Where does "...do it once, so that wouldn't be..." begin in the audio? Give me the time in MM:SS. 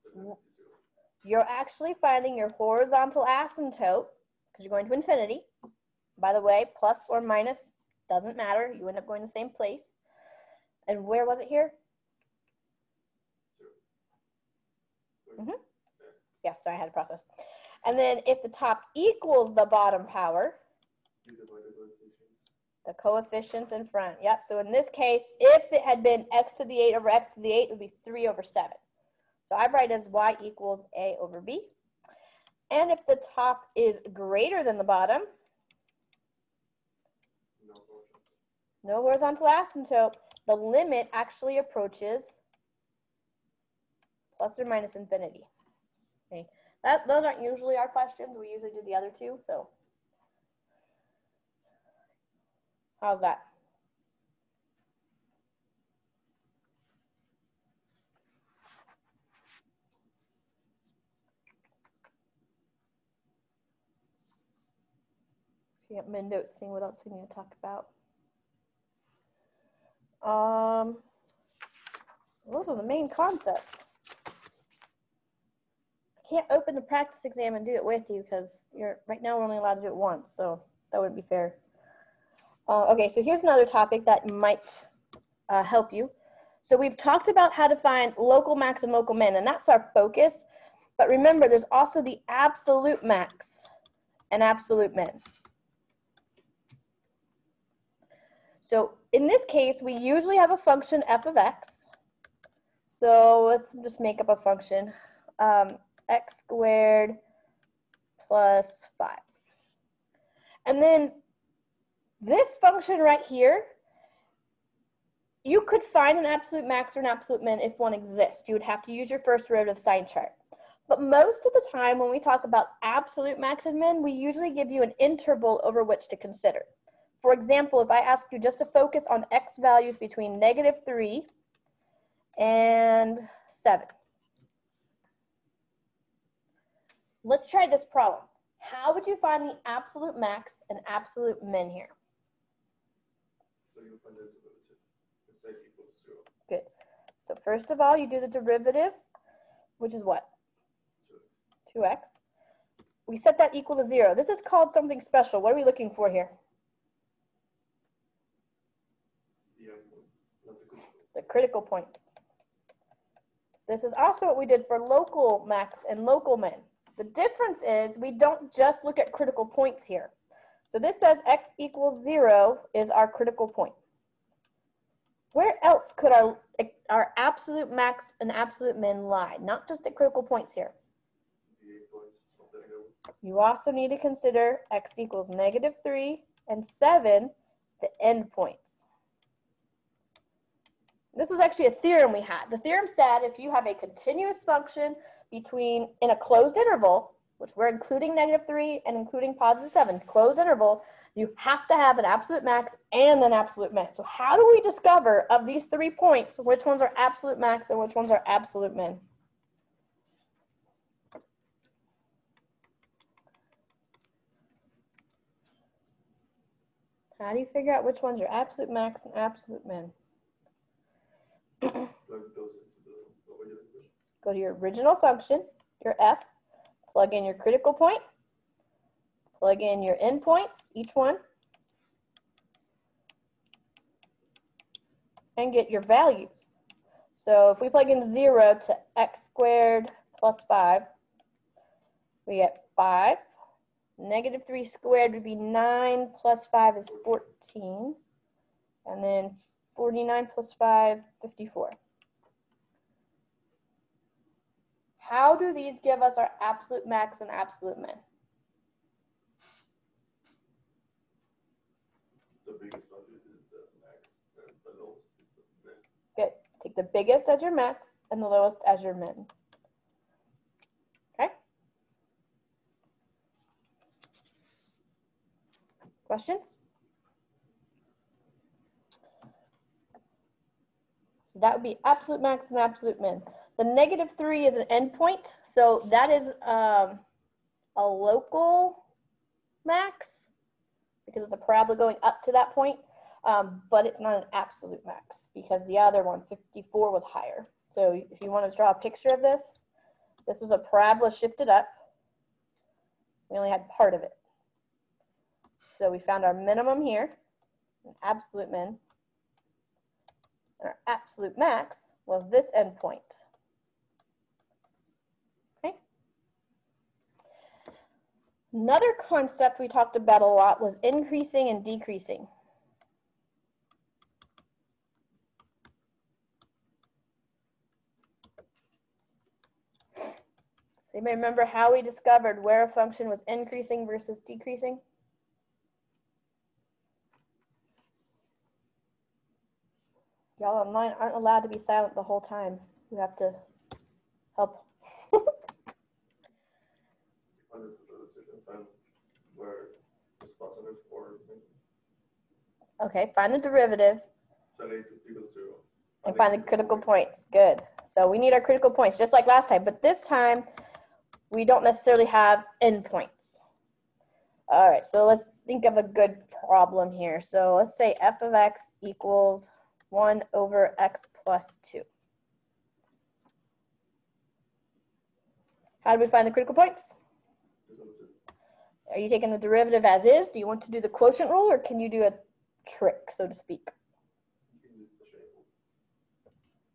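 01:19.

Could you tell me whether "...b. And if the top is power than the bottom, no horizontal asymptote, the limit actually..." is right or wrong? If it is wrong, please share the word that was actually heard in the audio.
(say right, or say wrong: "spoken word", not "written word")
wrong: "greater", not "power".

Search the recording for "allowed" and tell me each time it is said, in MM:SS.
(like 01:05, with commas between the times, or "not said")
01:19, 05:41.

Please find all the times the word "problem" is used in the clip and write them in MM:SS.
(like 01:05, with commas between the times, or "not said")
02:17, 06:06.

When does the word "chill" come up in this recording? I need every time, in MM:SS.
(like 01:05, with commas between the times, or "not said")
not said.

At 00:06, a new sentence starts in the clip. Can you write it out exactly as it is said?
By the way, plus or minus doesn't matter.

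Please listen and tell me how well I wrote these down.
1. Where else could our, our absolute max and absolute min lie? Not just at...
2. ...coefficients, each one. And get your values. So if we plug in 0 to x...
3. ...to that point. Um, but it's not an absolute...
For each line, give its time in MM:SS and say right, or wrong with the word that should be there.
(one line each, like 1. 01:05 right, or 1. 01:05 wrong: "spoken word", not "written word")
1. 02:55 right
2. 03:49 wrong: "endpoints", not "coefficients"
3. 04:52 right.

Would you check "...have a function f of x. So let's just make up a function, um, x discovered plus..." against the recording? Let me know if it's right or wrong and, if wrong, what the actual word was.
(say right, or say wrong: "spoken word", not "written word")
wrong: "squared", not "discovered".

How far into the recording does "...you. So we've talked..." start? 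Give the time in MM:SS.
01:25.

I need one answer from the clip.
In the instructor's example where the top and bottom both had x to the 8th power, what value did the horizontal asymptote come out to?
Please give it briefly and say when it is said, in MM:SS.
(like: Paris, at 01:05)
3/7, at 00:28.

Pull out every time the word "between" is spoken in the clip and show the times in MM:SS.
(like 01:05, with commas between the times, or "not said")
02:09, 03:15.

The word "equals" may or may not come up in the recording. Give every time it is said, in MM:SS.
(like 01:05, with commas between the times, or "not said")
00:18, 00:30, 02:25, 02:33, 02:51, 03:04, 06:08.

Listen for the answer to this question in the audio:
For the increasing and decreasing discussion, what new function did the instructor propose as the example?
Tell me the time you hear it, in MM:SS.
06:09.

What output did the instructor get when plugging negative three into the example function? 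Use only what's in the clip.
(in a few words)
14.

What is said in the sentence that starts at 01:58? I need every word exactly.
You would have to use your first derivative sign chart.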